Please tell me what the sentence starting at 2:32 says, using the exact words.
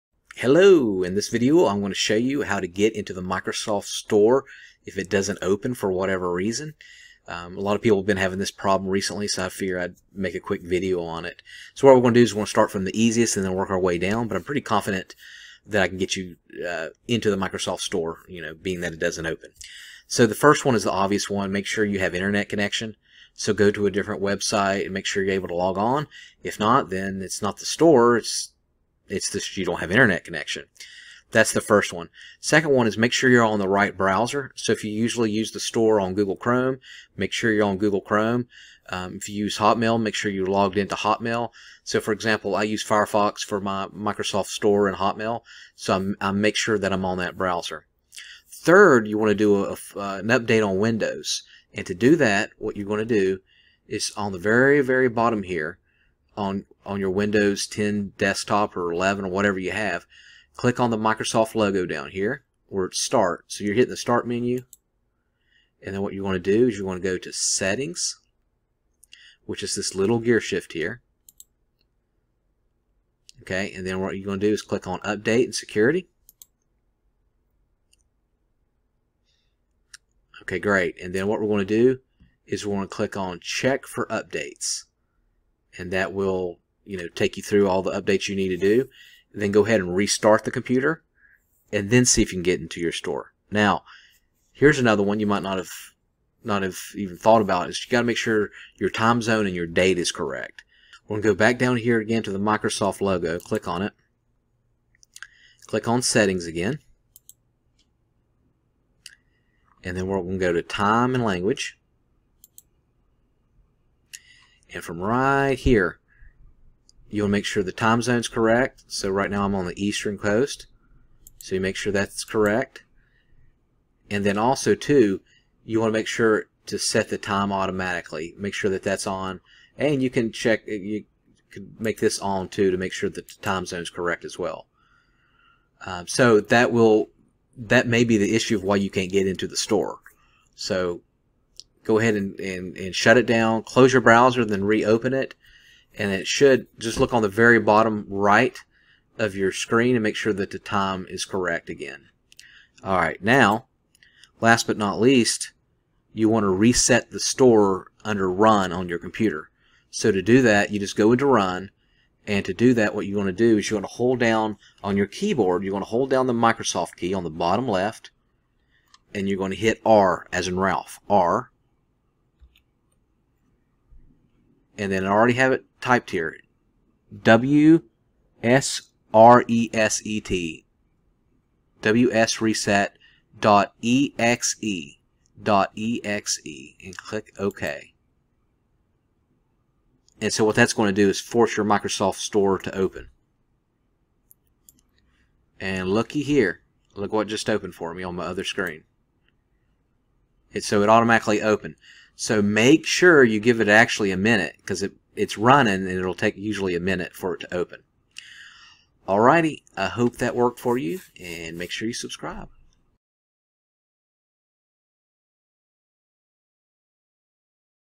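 All right, now, last but not least, you want to reset the store under run on your computer.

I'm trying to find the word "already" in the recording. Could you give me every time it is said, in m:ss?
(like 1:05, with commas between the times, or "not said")
2:55.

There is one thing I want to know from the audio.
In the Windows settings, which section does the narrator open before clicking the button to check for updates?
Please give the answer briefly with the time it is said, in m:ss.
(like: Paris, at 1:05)
Update and Security, at 1:14.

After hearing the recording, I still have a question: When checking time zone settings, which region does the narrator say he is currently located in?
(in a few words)
Eastern coast.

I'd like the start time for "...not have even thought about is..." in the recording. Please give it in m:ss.
1:36.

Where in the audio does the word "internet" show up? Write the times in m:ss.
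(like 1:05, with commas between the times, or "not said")
0:22, 0:29.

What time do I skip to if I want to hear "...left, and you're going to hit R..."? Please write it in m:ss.
2:47.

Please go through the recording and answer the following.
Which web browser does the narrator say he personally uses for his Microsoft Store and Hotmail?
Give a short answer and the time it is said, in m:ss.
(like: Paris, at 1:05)
Firefox, at 0:42.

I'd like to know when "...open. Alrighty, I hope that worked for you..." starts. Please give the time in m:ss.
3:27.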